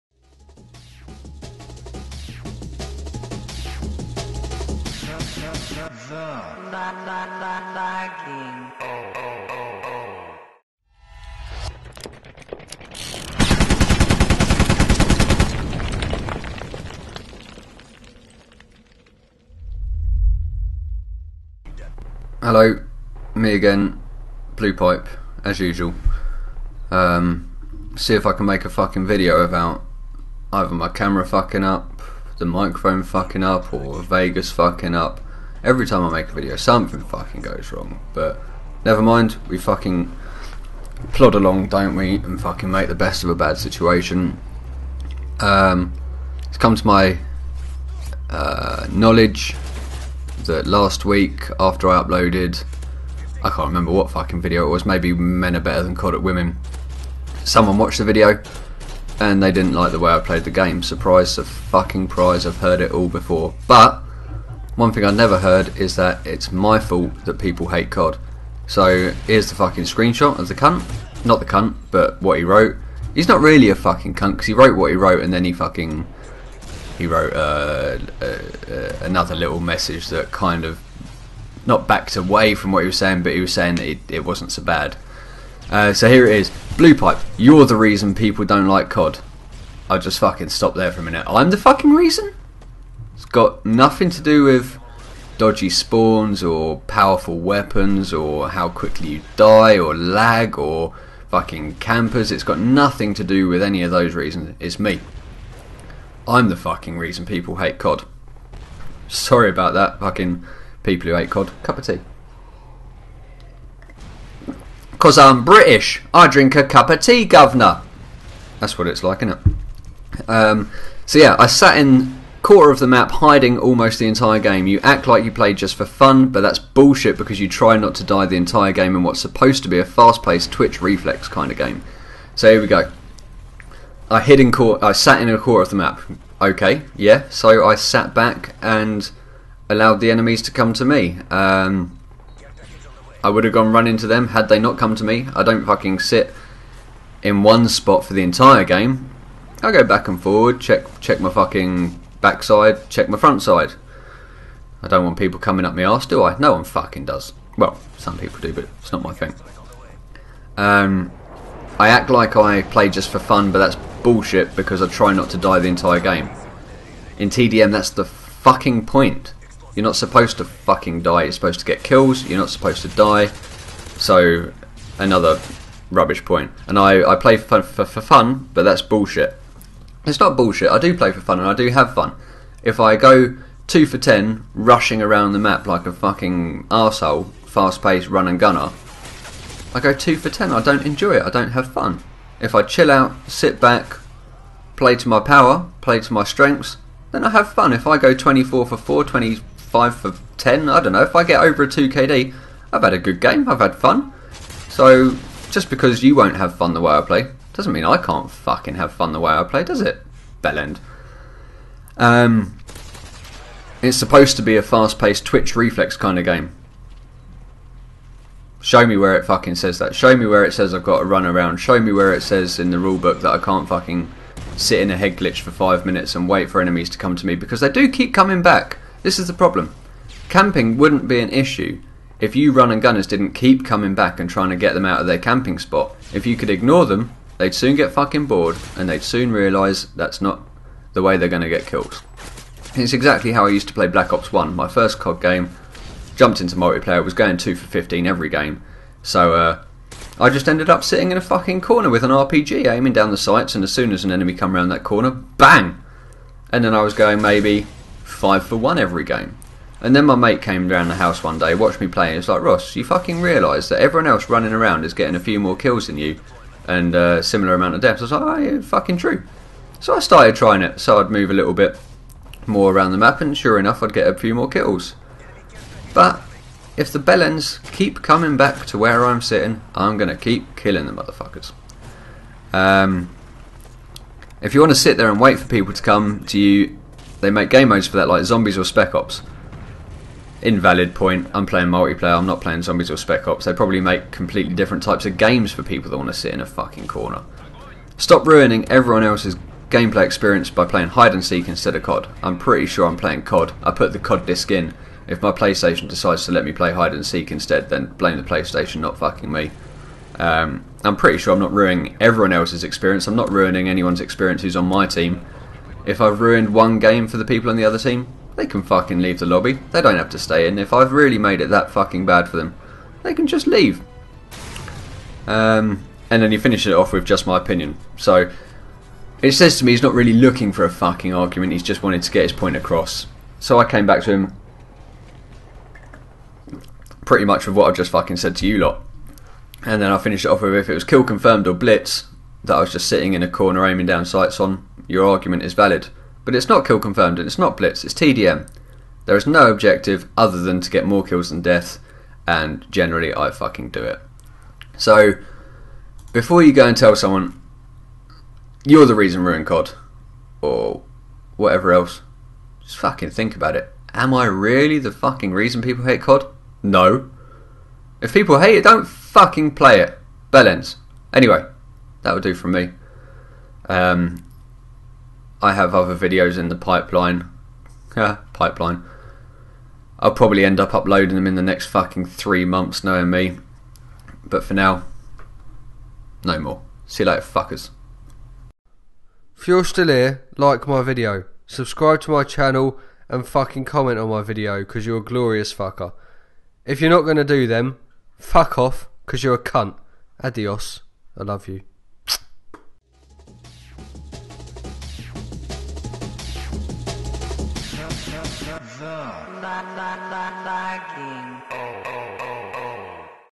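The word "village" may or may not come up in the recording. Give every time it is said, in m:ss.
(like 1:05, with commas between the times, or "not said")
not said.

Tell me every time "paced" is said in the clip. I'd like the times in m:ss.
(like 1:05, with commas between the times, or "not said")
2:10, 3:07, 3:34.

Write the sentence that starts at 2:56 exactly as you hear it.
And I, I play for, for, for fun, but that's bullshit.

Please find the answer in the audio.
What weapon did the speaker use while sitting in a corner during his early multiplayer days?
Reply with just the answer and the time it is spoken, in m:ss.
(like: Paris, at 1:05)
RPG, at 4:12.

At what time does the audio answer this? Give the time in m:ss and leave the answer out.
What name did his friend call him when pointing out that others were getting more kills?
4:22.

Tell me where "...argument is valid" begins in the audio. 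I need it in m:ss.
5:45.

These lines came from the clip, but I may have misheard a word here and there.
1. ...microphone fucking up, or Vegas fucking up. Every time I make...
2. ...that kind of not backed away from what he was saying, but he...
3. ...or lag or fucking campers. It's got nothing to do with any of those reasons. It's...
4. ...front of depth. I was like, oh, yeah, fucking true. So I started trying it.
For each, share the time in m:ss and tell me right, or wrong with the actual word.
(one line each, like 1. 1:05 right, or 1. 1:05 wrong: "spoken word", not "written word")
1. 0:32 right
2. 1:20 right
3. 1:39 right
4. 4:27 wrong: "amount", not "front".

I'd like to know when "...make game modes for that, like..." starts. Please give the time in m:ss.
4:47.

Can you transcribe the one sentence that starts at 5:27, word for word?
So it says to me he's not really looking for a fucking argument.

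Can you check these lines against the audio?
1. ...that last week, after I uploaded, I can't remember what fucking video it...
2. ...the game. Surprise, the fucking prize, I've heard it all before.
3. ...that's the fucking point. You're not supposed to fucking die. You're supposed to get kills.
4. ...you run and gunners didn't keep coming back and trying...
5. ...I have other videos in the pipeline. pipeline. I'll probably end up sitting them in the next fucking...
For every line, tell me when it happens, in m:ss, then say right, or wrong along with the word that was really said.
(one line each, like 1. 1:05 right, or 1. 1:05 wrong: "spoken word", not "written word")
1. 0:50 right
2. 1:00 right
3. 2:47 right
4. 3:52 right
5. 6:15 wrong: "uploading", not "sitting".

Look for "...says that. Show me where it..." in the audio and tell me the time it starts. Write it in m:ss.
3:39.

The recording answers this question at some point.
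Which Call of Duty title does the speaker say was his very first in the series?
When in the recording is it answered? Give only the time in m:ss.
4:03.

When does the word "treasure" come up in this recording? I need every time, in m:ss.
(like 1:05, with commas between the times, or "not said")
not said.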